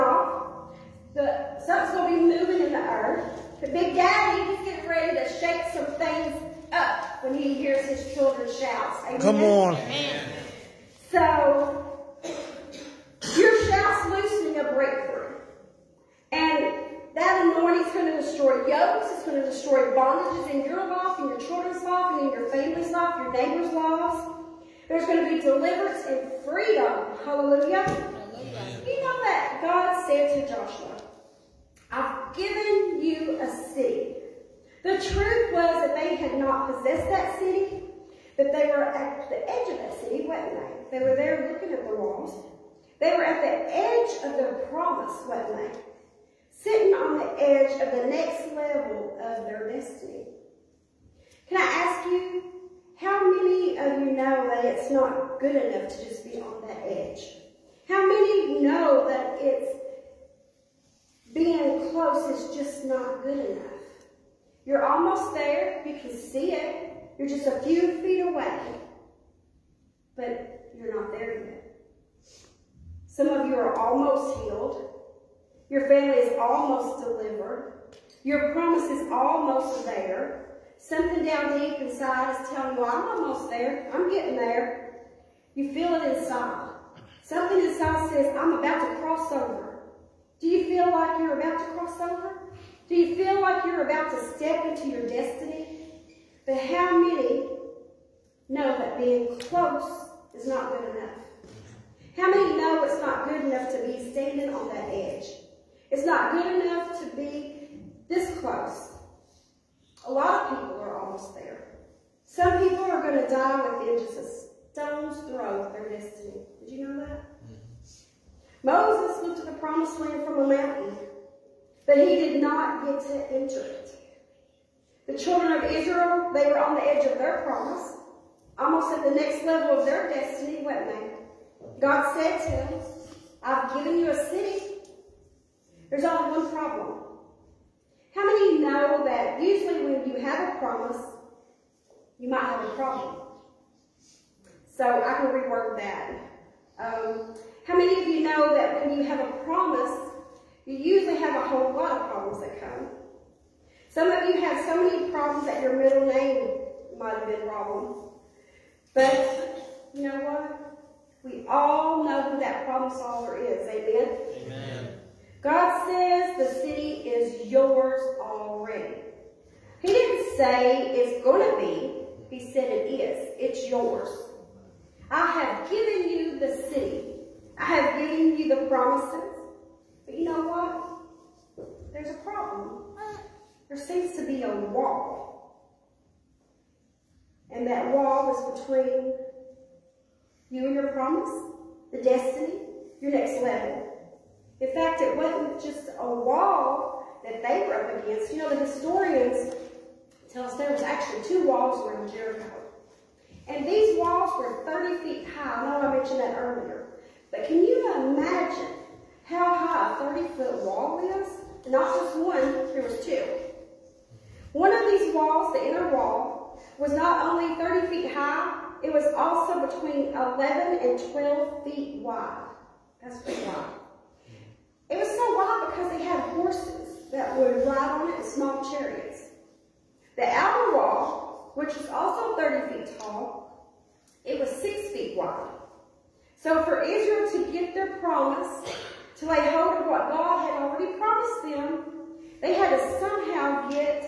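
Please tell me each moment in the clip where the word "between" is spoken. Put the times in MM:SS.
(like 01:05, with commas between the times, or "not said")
03:08, 03:39.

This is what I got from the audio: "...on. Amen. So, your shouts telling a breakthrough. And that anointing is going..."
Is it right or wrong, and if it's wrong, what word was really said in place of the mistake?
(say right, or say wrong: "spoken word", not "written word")
wrong: "loosening", not "telling".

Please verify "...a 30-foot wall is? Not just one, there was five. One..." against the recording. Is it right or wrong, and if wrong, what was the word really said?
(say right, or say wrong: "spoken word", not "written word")
wrong: "two", not "five".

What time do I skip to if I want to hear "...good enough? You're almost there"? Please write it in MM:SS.
01:03.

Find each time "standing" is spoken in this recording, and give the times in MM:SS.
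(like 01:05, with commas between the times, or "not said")
01:44.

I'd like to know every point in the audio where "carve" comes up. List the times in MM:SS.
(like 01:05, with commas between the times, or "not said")
not said.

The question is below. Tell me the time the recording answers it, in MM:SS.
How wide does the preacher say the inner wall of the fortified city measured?
03:39.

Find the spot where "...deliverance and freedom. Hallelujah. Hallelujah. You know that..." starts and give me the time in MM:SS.
00:25.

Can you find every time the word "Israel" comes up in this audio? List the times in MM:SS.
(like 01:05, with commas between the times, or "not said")
02:05, 03:56.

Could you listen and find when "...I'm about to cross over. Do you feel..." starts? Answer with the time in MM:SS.
01:28.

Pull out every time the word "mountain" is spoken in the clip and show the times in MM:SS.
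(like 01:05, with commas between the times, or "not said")
02:00.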